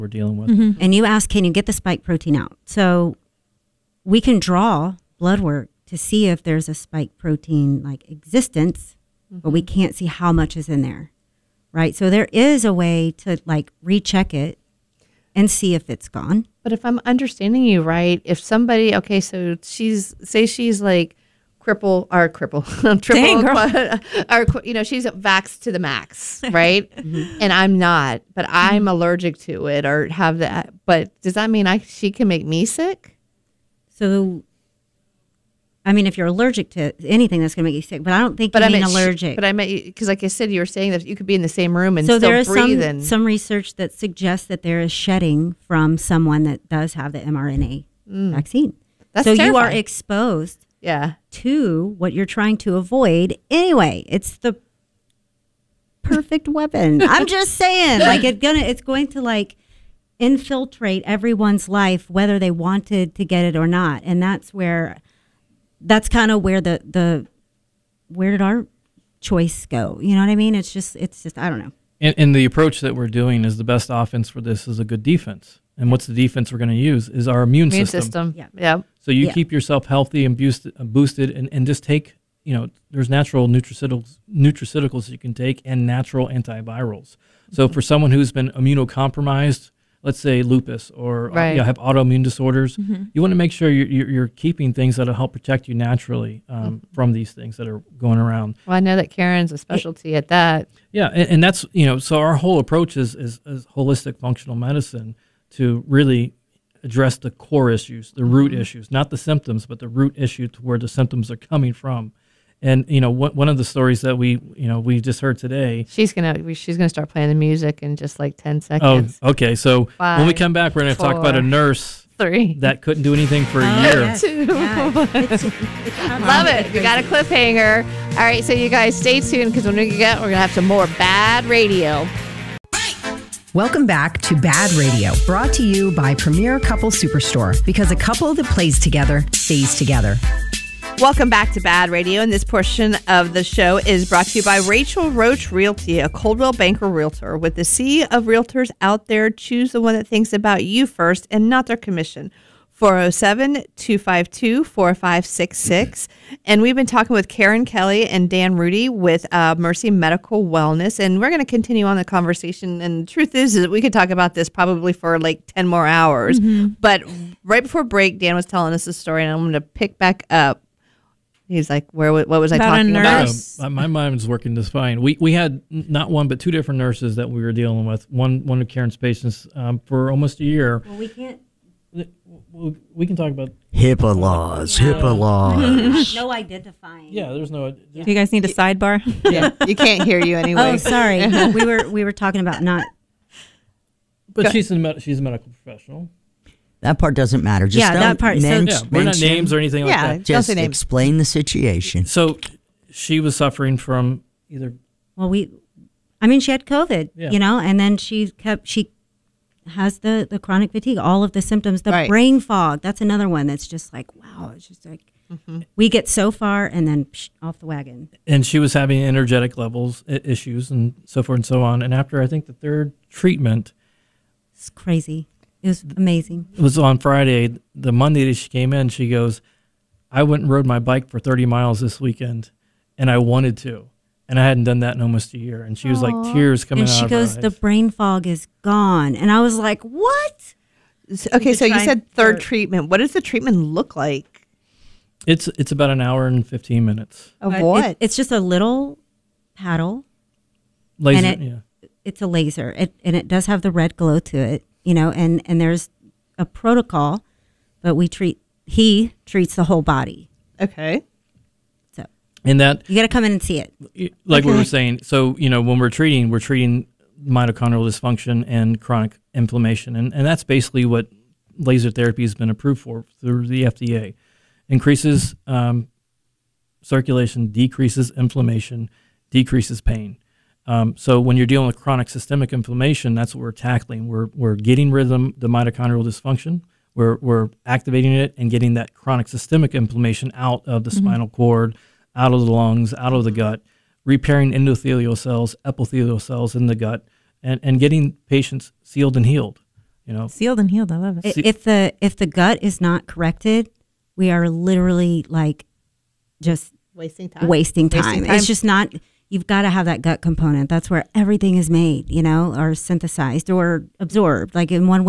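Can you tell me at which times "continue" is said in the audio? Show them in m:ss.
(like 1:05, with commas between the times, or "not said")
2:41.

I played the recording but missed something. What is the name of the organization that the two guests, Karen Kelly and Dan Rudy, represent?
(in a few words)
Mercy Medical Wellness.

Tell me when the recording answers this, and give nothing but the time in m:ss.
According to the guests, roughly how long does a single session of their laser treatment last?
4:05.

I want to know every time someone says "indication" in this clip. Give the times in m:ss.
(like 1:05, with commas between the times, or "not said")
not said.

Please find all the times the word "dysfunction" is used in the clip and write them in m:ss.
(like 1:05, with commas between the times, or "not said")
4:27, 4:46.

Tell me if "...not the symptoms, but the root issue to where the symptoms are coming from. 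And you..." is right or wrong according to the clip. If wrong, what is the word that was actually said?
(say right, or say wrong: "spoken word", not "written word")
right.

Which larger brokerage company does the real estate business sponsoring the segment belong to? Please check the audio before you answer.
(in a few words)
Coldwell Banker.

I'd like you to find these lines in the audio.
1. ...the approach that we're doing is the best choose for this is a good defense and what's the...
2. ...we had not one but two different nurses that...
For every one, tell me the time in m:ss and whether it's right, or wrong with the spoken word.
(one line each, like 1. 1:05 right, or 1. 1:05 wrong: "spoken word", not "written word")
1. 1:12 wrong: "offense", not "choose"
2. 2:55 right.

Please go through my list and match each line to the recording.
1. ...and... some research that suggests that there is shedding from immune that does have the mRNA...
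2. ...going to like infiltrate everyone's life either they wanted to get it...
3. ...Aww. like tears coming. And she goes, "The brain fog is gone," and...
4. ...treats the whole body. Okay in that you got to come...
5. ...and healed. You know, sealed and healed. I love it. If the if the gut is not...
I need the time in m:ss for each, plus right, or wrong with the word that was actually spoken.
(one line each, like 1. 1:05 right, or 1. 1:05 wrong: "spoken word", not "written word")
1. 0:42 wrong: "someone", not "immune"
2. 0:58 wrong: "whether", not "either"
3. 3:55 right
4. 4:19 right
5. 4:59 right.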